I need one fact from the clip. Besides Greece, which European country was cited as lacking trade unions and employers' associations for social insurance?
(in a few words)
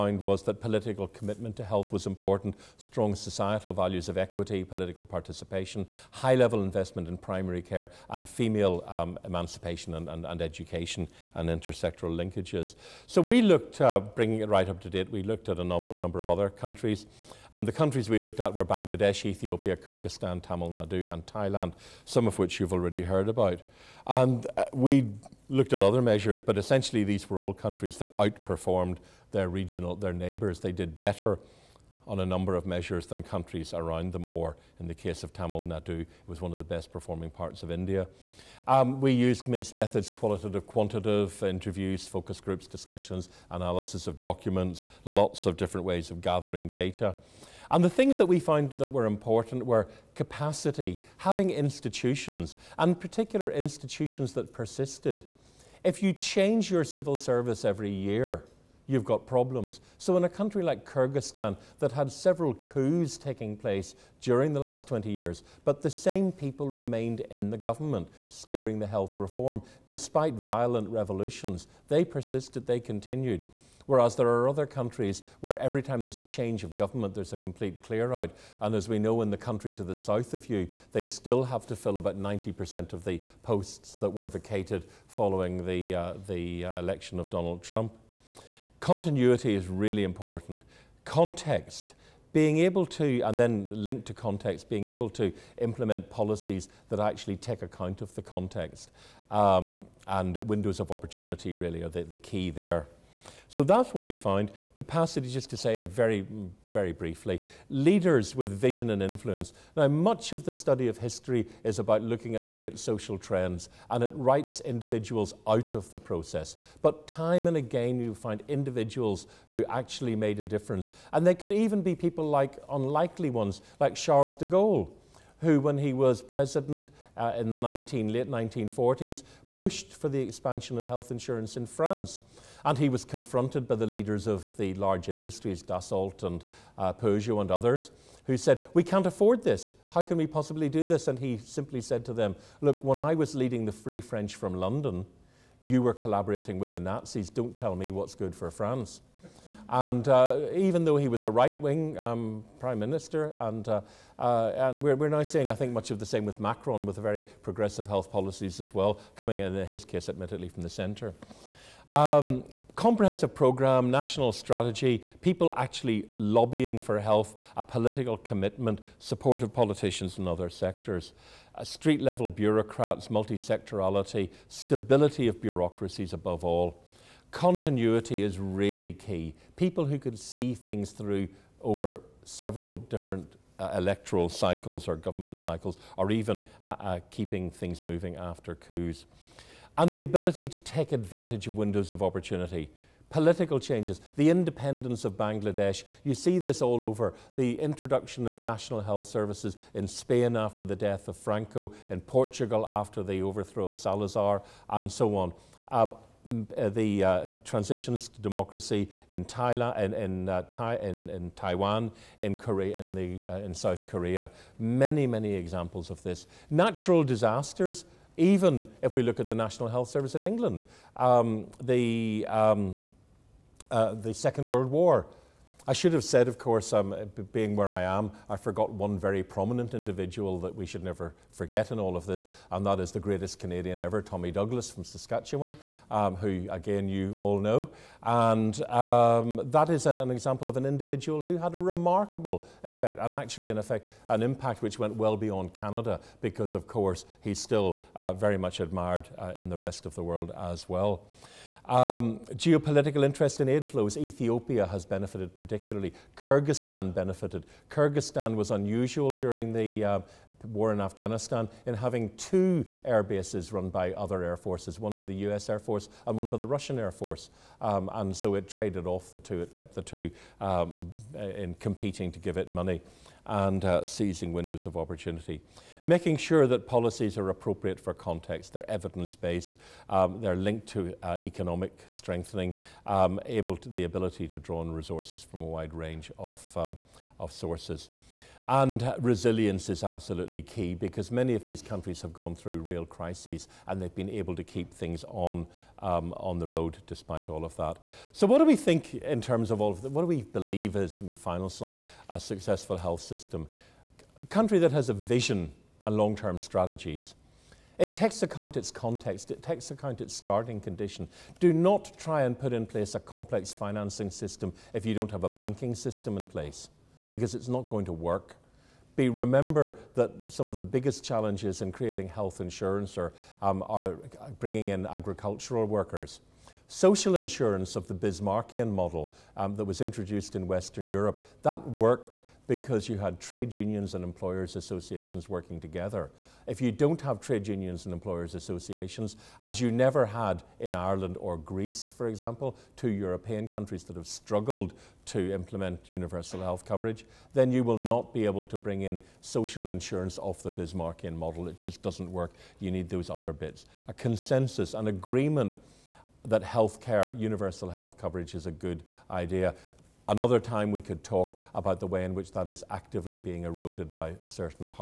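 Ireland.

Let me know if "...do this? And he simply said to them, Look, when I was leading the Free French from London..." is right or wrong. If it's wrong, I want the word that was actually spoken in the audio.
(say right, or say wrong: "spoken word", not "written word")
right.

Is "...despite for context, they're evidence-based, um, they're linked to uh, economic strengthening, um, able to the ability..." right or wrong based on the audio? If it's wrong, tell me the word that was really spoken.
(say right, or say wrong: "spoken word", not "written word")
wrong: "appropriate", not "despite".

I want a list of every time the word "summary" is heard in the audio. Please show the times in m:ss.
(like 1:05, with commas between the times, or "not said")
not said.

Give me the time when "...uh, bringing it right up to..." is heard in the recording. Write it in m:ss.
0:13.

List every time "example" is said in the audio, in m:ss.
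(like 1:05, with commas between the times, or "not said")
3:35, 4:00, 5:42.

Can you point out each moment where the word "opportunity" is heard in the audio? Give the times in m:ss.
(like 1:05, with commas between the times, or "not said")
1:40, 3:12, 4:34.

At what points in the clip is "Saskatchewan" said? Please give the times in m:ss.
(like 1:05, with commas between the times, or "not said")
3:54.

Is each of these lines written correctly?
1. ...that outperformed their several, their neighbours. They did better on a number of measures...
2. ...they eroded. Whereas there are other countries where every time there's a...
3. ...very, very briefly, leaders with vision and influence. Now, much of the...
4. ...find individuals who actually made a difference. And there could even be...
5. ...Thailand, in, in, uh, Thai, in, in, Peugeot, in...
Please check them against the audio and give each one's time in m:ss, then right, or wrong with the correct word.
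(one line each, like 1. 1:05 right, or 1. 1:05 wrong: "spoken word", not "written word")
1. 0:27 wrong: "regional", not "several"
2. 1:12 wrong: "continued", not "eroded"
3. 1:45 right
4. 1:58 right
5. 3:29 wrong: "Taiwan", not "Peugeot".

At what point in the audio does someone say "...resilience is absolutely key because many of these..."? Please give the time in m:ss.
4:49.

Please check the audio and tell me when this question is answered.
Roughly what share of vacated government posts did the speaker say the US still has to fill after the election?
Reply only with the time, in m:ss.
1:22.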